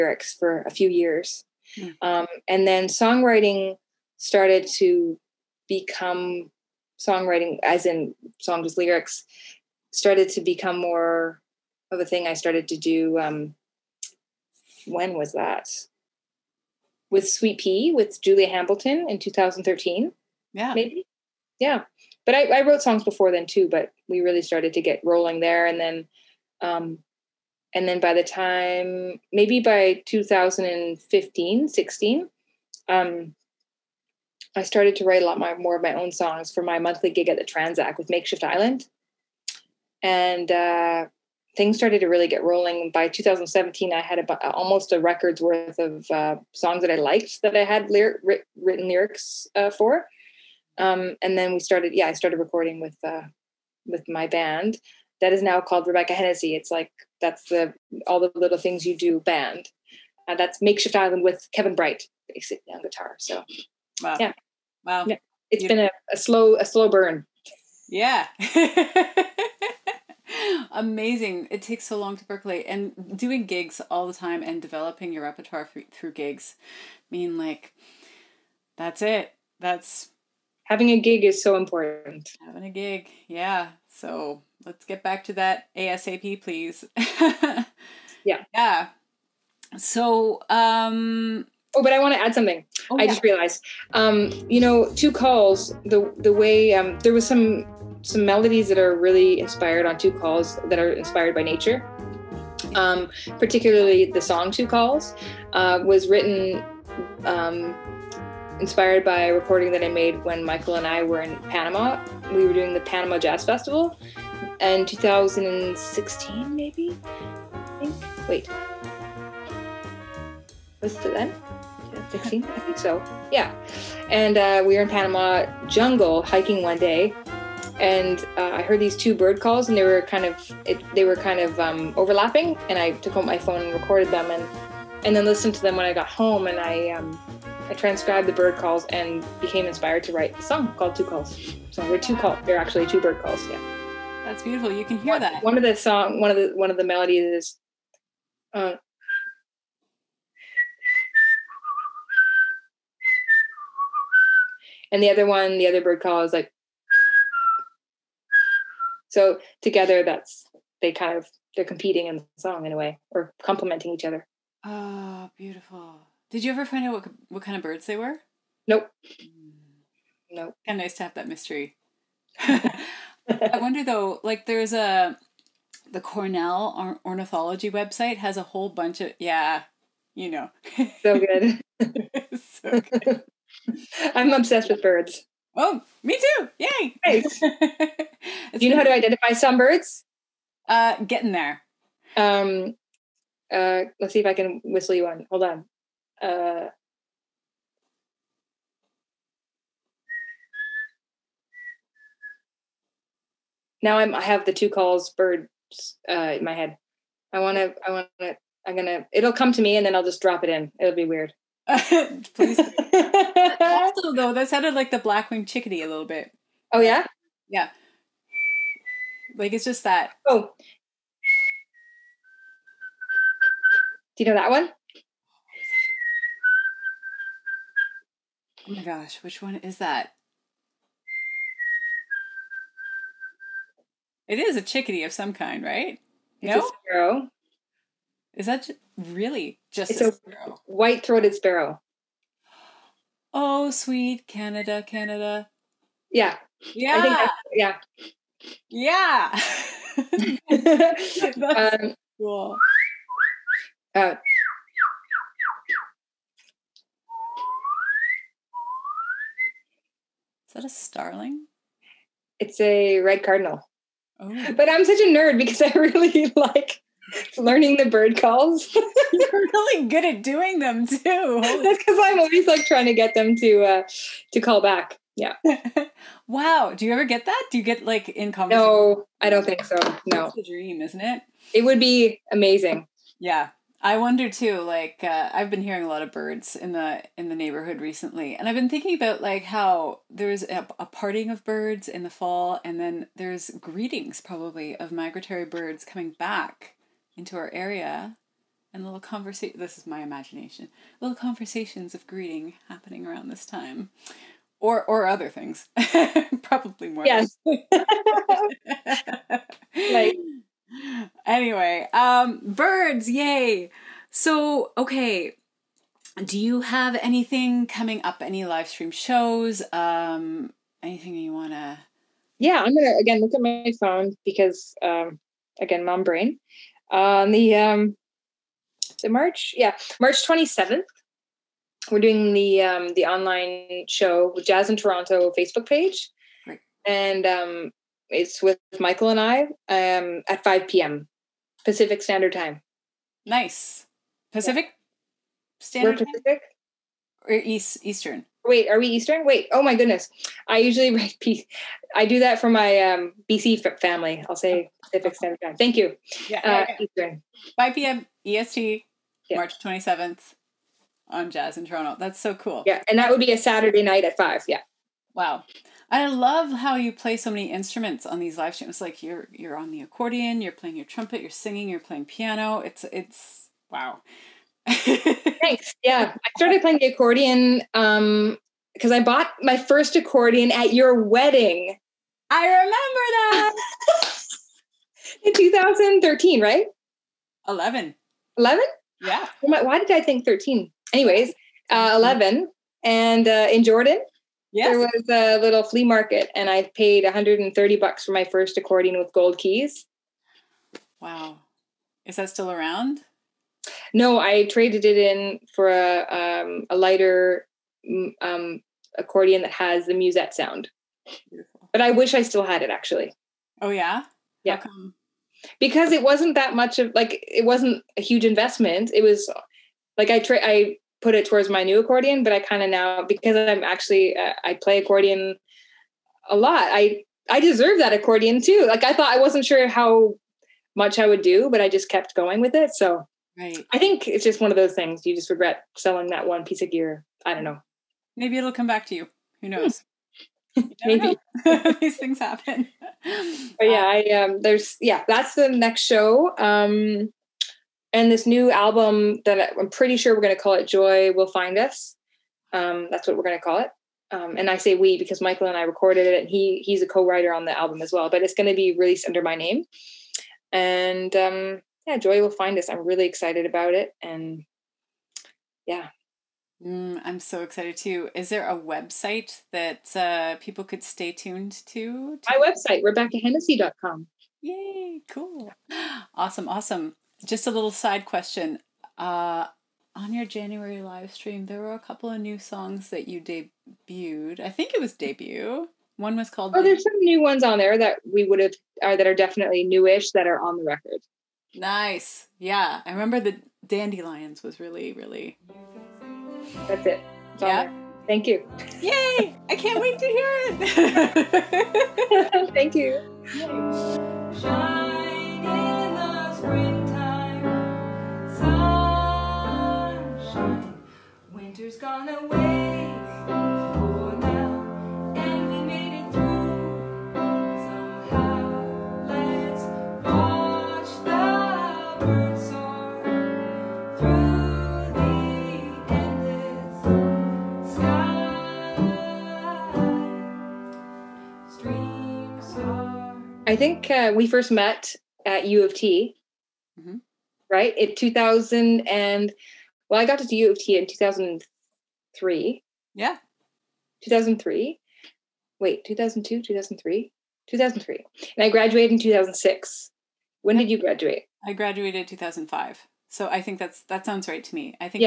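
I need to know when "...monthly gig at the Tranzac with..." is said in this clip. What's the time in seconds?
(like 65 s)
36 s.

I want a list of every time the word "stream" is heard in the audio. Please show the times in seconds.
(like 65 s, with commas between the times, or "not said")
318 s, 368 s, 481 s.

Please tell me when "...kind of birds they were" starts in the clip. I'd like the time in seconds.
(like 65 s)
167 s.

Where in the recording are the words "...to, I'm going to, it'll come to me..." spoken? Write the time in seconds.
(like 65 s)
208 s.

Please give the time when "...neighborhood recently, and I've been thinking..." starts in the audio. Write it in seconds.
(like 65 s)
287 s.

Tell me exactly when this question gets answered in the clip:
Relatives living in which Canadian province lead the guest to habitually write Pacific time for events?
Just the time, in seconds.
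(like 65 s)
353 s.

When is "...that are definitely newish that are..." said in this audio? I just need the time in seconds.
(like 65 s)
488 s.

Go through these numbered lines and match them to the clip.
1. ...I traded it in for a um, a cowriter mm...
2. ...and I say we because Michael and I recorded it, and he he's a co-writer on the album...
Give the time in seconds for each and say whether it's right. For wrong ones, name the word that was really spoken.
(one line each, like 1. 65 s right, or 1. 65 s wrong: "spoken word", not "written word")
1. 404 s wrong: "lighter", not "cowriter"
2. 454 s right.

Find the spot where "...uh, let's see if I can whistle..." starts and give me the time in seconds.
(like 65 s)
193 s.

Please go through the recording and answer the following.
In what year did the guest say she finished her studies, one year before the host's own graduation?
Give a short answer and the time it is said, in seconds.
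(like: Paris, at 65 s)
2005, at 552 s.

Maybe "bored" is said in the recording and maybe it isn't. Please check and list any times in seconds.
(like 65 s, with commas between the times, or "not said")
not said.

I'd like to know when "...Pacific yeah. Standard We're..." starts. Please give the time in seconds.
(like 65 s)
344 s.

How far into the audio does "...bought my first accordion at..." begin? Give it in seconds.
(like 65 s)
379 s.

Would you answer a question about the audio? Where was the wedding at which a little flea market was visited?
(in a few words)
Jordan.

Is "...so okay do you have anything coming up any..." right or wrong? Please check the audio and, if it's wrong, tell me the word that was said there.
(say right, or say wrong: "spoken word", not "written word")
right.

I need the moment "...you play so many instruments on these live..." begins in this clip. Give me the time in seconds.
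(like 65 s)
366 s.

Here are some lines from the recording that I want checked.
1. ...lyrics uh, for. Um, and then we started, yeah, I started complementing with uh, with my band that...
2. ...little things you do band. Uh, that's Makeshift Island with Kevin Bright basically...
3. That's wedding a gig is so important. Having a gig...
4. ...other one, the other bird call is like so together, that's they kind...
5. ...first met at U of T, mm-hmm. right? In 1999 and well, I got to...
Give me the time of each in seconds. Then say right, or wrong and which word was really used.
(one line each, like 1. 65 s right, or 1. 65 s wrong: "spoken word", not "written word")
1. 48 s wrong: "recording", not "complementing"
2. 58 s right
3. 79 s wrong: "having", not "wedding"
4. 155 s right
5. 534 s wrong: "2000", not "1999".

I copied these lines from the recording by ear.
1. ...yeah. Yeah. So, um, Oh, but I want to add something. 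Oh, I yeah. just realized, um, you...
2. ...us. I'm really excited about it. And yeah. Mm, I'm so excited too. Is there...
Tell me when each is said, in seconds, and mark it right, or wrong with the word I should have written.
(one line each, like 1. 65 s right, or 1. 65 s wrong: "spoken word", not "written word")
1. 88 s right
2. 462 s right.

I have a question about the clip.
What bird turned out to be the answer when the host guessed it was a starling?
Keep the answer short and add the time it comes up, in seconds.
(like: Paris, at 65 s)
Red cardinal, at 262 s.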